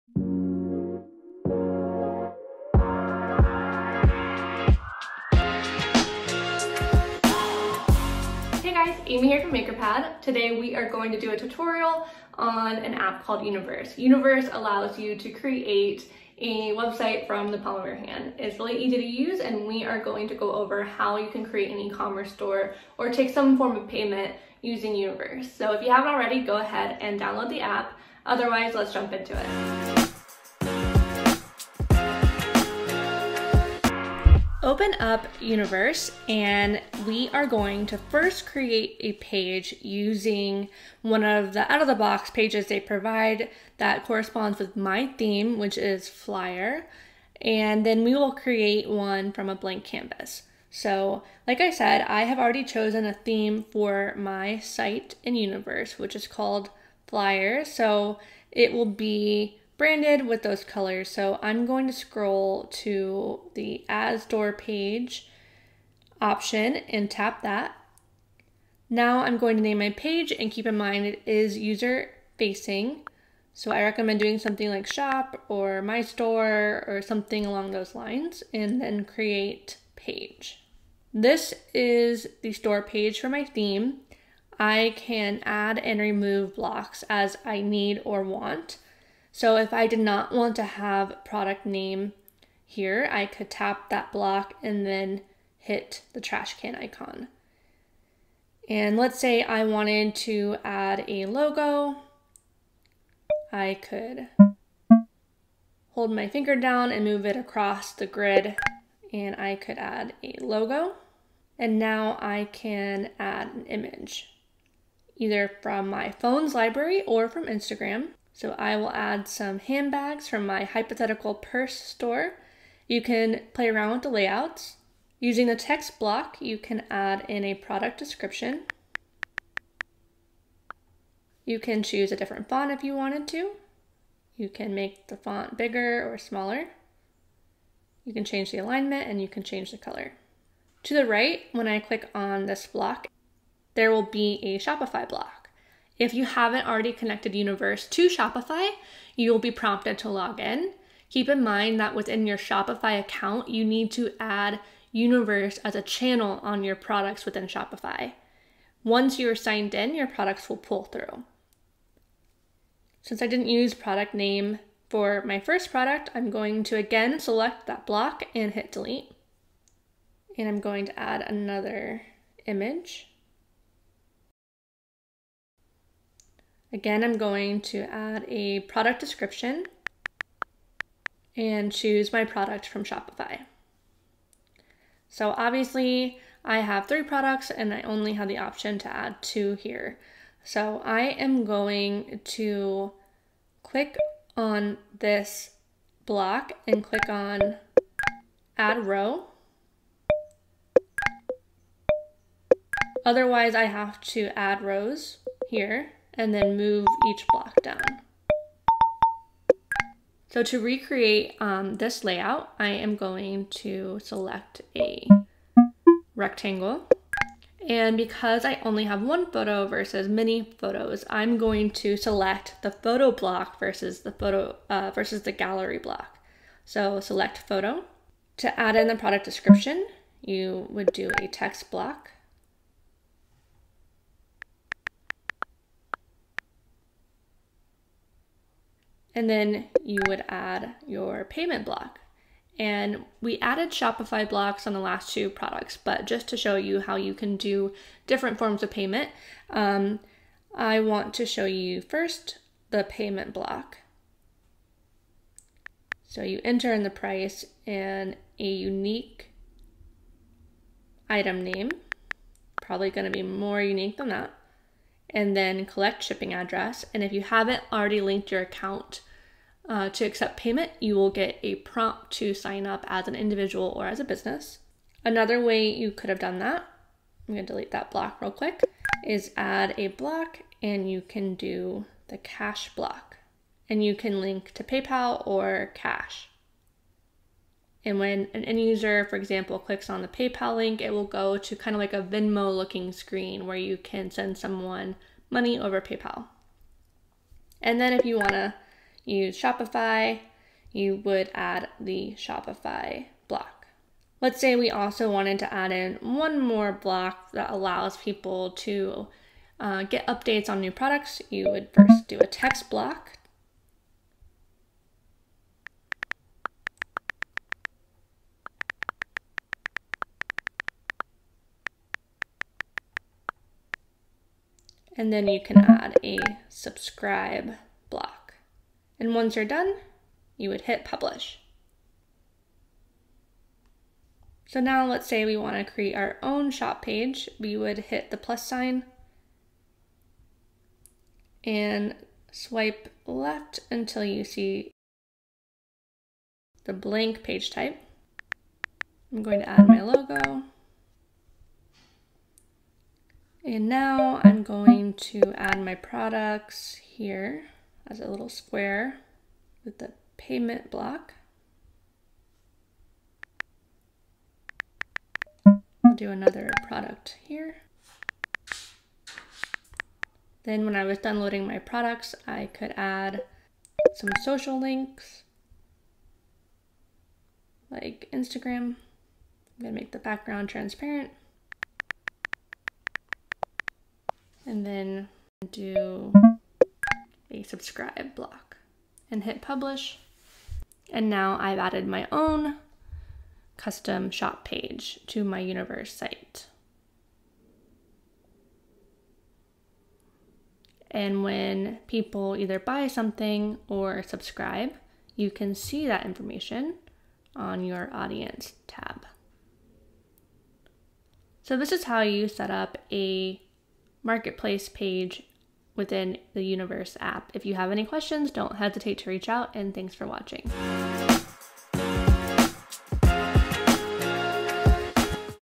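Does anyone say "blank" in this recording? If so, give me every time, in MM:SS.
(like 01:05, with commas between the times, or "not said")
00:49, 05:46.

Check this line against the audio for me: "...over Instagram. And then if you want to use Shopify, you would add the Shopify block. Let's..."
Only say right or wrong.
wrong.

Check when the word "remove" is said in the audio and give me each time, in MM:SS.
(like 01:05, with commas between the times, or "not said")
01:25.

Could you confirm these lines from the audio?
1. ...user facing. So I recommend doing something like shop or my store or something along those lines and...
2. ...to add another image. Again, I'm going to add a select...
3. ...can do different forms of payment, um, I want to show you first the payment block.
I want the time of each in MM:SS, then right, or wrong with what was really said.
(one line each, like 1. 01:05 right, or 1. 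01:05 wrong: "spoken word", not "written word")
1. 01:11 right
2. 02:50 wrong: "product", not "select"
3. 04:07 right.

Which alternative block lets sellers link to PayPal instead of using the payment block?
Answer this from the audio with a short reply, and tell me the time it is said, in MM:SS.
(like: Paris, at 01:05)
cash block, at 04:42.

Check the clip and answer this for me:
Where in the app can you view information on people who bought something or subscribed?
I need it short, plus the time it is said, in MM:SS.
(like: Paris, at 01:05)
audience tab, at 06:47.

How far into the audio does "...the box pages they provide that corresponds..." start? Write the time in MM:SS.
00:41.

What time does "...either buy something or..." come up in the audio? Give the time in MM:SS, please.
06:42.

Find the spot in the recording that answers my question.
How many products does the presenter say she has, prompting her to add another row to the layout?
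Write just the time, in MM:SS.
03:06.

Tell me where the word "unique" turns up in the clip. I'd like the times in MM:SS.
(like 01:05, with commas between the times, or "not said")
04:18, 04:23.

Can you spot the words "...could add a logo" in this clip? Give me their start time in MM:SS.
01:49.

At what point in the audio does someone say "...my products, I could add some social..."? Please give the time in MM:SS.
06:11.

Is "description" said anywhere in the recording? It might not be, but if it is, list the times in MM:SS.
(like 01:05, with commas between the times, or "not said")
02:07, 02:59, 03:49.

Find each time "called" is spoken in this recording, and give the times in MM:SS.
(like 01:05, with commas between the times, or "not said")
00:13, 00:56.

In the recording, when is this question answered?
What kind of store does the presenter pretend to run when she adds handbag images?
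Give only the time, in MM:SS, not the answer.
02:00.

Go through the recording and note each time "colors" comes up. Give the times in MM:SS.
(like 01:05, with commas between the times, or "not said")
01:00, 02:19.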